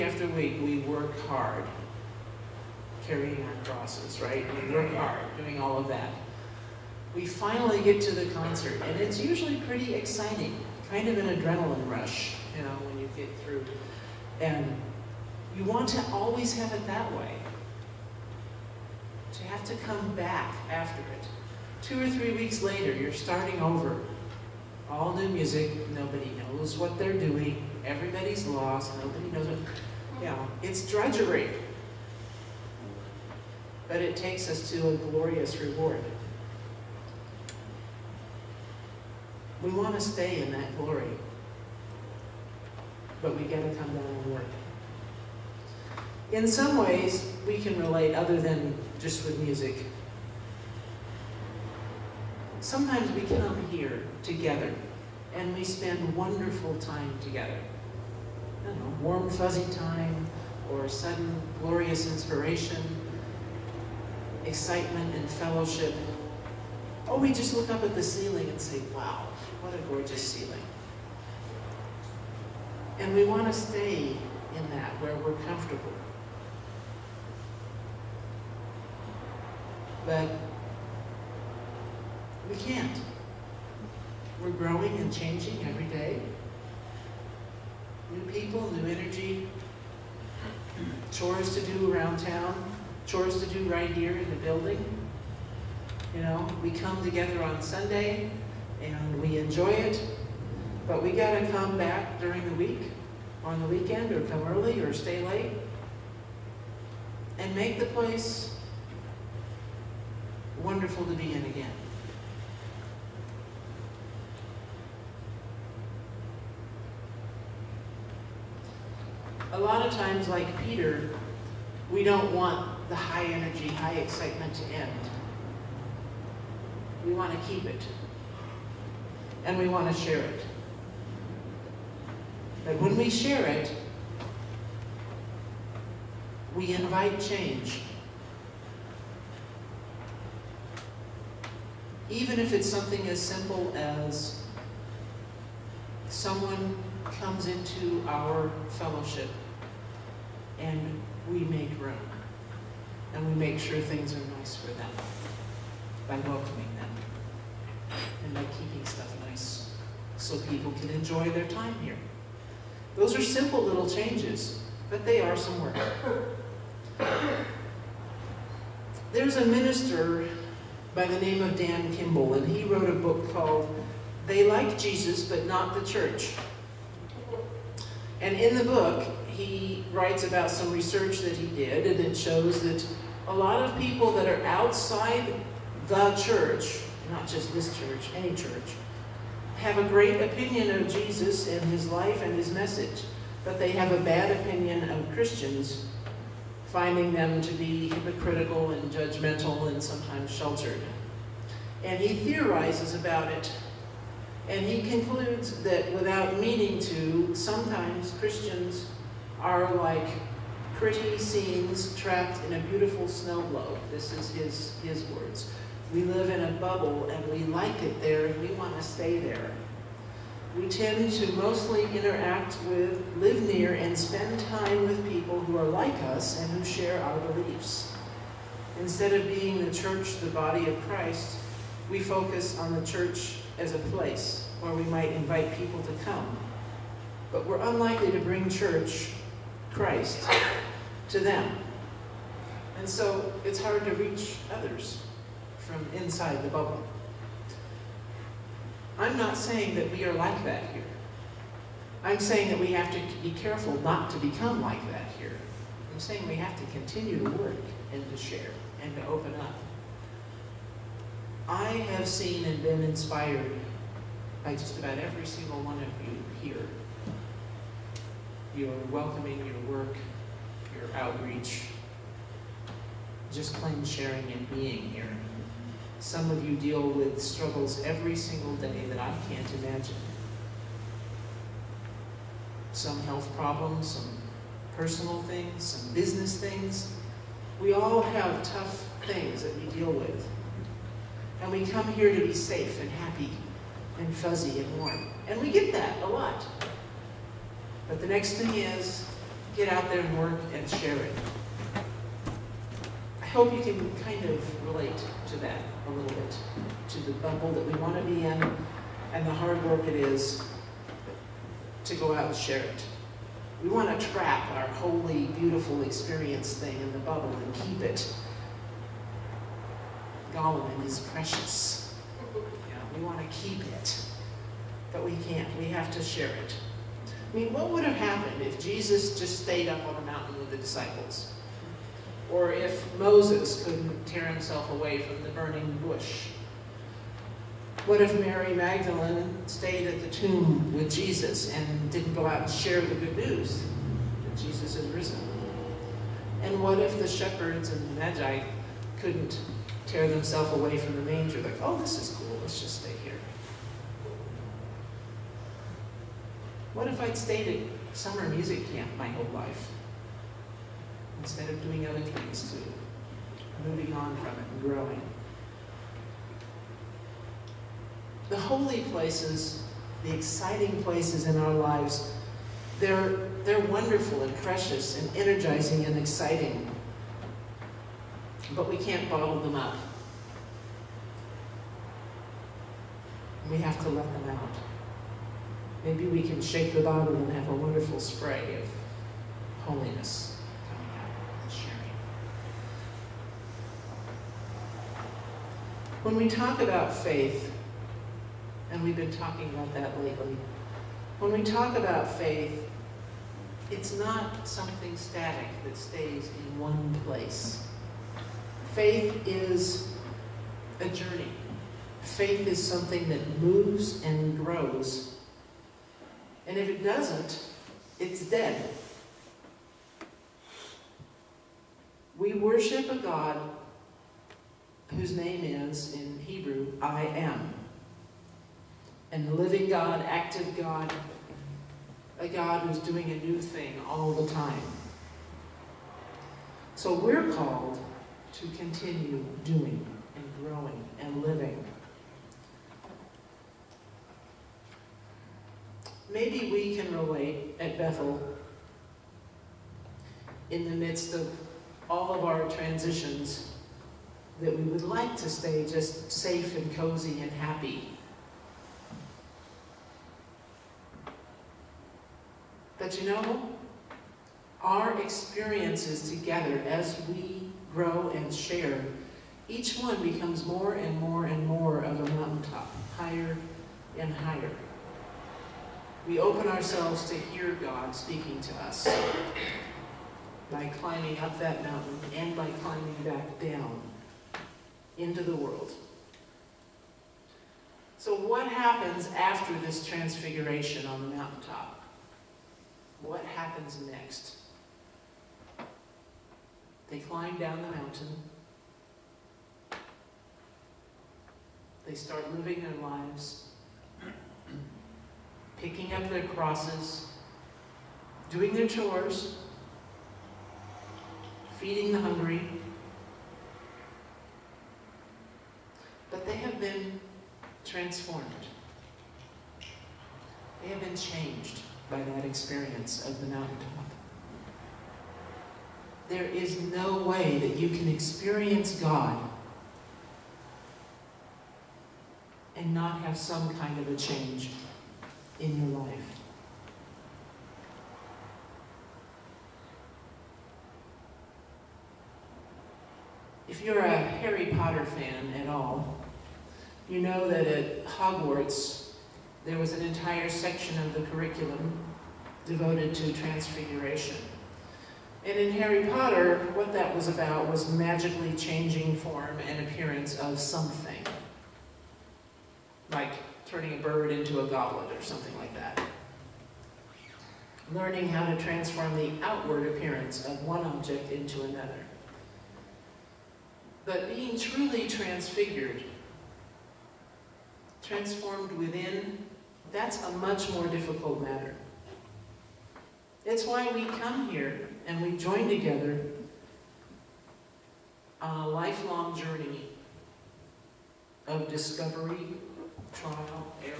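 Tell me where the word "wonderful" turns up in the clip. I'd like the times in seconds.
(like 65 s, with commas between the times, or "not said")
56 s, 110 s, 373 s, 387 s.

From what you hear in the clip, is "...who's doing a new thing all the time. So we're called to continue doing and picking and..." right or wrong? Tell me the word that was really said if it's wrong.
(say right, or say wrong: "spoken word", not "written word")
wrong: "growing", not "picking".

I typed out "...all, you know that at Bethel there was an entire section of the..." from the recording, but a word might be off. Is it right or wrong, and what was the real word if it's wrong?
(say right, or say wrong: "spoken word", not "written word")
wrong: "Hogwarts", not "Bethel".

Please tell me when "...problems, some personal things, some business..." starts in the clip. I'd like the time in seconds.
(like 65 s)
283 s.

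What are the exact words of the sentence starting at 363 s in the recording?
Moving on from it and growing.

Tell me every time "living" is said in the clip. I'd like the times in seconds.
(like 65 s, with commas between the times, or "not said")
429 s, 441 s, 502 s.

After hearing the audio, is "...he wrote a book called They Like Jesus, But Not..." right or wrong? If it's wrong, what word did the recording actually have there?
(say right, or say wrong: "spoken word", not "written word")
right.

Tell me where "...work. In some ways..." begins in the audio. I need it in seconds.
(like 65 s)
44 s.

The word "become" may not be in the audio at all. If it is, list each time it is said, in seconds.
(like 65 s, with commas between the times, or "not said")
254 s, 470 s.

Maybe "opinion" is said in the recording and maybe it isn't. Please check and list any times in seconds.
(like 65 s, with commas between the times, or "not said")
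190 s, 194 s.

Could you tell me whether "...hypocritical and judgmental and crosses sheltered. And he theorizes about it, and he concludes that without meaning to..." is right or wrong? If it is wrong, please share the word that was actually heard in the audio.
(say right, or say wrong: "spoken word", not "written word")
wrong: "sometimes", not "crosses".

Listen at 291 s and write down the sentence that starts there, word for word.
And we come here to be safe and happy and fuzzy and warm.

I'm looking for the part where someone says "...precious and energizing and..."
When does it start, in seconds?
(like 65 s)
374 s.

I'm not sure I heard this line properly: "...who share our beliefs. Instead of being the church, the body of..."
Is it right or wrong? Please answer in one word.
right.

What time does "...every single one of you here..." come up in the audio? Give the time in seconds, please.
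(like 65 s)
264 s.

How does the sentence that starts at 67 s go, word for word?
Or oh, we just look up at the ceiling and say, wow, what a gorgeous ceiling.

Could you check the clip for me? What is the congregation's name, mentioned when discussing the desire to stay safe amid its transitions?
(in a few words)
Bethel.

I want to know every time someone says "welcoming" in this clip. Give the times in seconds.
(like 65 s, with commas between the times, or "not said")
156 s, 268 s.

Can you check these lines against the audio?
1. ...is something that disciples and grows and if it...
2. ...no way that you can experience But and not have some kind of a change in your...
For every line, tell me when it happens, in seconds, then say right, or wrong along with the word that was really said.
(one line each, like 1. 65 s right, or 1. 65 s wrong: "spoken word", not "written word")
1. 412 s wrong: "moves", not "disciples"
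2. 526 s wrong: "God", not "But".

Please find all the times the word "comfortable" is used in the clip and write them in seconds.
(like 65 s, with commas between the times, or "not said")
75 s.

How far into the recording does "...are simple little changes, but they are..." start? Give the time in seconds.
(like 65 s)
163 s.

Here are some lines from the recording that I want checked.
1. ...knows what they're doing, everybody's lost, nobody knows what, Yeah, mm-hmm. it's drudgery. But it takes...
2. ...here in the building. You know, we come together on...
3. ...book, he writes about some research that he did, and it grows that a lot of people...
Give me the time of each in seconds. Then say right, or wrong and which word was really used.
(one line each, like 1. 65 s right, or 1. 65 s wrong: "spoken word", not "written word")
1. 26 s right
2. 93 s right
3. 178 s wrong: "shows", not "grows".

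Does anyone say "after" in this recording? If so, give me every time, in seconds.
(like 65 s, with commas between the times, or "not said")
0 s, 20 s, 489 s.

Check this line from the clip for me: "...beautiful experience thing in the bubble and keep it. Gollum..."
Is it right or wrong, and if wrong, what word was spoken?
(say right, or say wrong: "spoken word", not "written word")
right.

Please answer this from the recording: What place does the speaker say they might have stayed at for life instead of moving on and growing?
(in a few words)
summer music camp.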